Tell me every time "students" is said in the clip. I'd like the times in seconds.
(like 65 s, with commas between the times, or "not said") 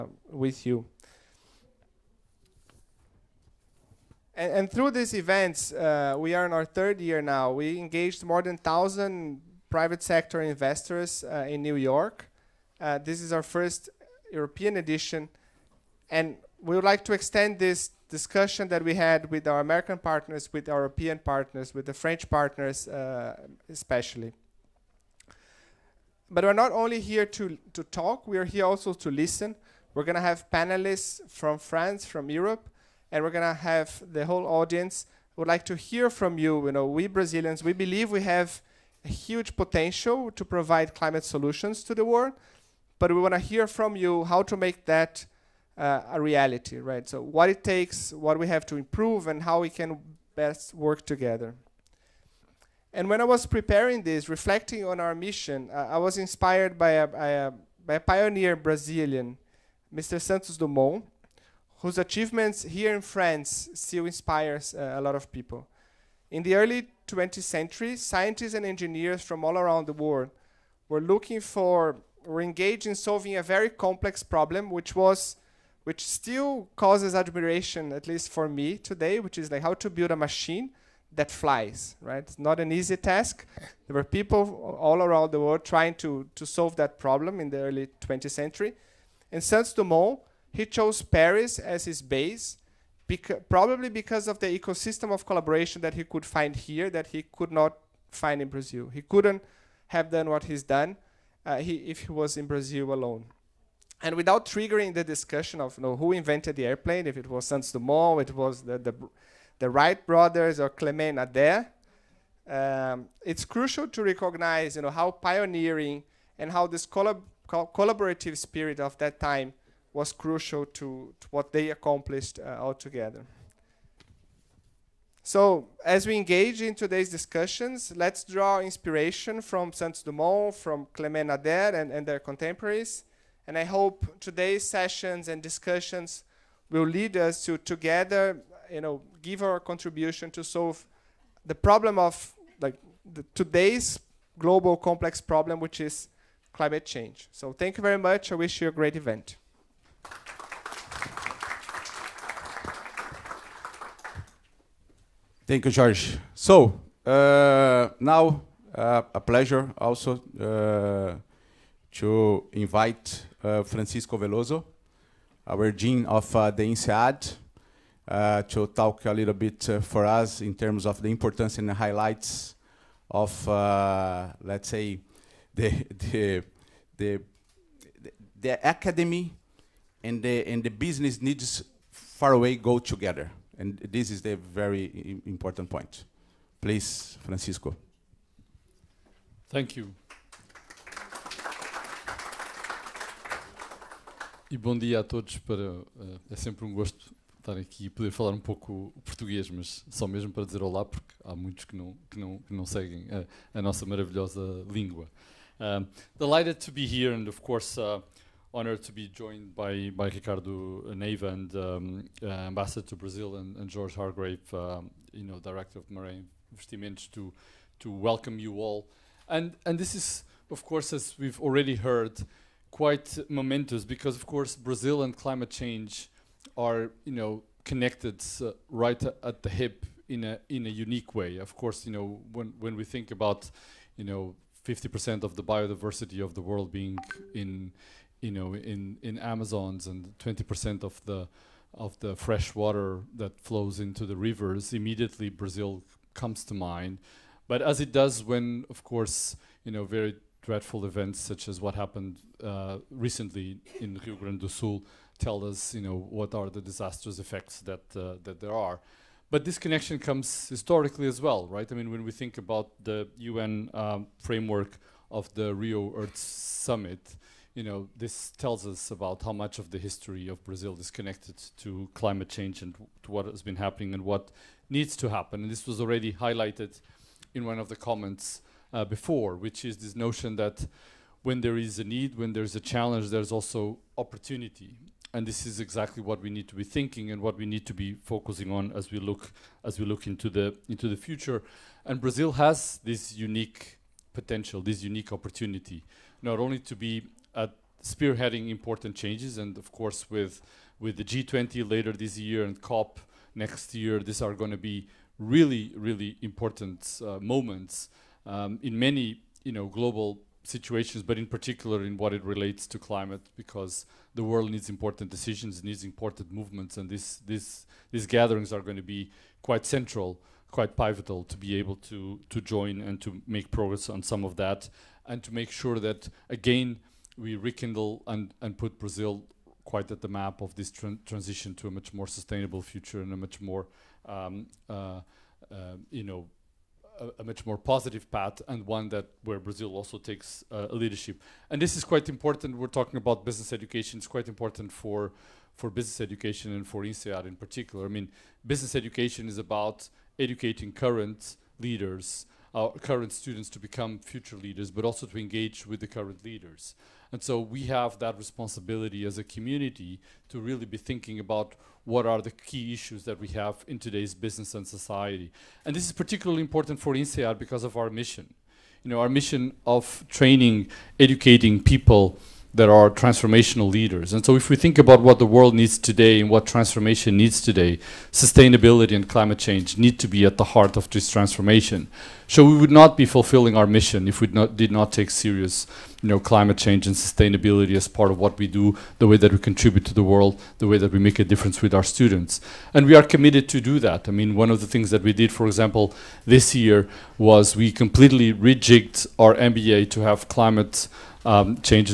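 353 s, 391 s.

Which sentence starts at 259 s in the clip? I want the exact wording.
But this connection comes historically as well, right?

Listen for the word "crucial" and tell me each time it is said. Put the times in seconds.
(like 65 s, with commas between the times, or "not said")
113 s, 120 s.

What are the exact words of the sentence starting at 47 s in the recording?
So what it takes, what we have to improve, and how we can best work together.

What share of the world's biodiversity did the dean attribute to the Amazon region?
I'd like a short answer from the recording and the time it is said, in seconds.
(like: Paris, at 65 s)
50%, at 234 s.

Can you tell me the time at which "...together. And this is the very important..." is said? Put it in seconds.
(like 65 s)
182 s.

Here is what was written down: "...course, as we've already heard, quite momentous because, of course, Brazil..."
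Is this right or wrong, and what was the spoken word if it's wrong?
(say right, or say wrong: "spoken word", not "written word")
right.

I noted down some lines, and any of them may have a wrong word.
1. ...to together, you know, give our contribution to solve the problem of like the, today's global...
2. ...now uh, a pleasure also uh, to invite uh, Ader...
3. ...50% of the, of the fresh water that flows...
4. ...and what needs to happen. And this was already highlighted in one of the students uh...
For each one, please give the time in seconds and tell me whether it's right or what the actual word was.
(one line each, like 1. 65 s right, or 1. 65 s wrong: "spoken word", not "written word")
1. 137 s right
2. 157 s wrong: "Francisco", not "Ader"
3. 240 s wrong: "20", not "50"
4. 273 s wrong: "comments", not "students".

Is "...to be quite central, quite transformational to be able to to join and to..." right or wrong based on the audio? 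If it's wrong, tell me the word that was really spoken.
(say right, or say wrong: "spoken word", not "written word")
wrong: "pivotal", not "transformational".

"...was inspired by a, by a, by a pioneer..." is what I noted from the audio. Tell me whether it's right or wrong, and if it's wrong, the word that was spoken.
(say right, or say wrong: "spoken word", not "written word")
right.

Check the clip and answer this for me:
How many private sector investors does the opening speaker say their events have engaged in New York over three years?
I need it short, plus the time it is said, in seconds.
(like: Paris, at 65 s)
more than 1,000, at 8 s.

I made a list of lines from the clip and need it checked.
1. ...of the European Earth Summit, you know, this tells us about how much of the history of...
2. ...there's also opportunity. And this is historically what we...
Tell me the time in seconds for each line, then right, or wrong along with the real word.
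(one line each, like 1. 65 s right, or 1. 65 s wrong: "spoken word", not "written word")
1. 265 s wrong: "Rio", not "European"
2. 283 s wrong: "exactly", not "historically".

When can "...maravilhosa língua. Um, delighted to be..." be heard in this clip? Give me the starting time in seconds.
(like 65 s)
203 s.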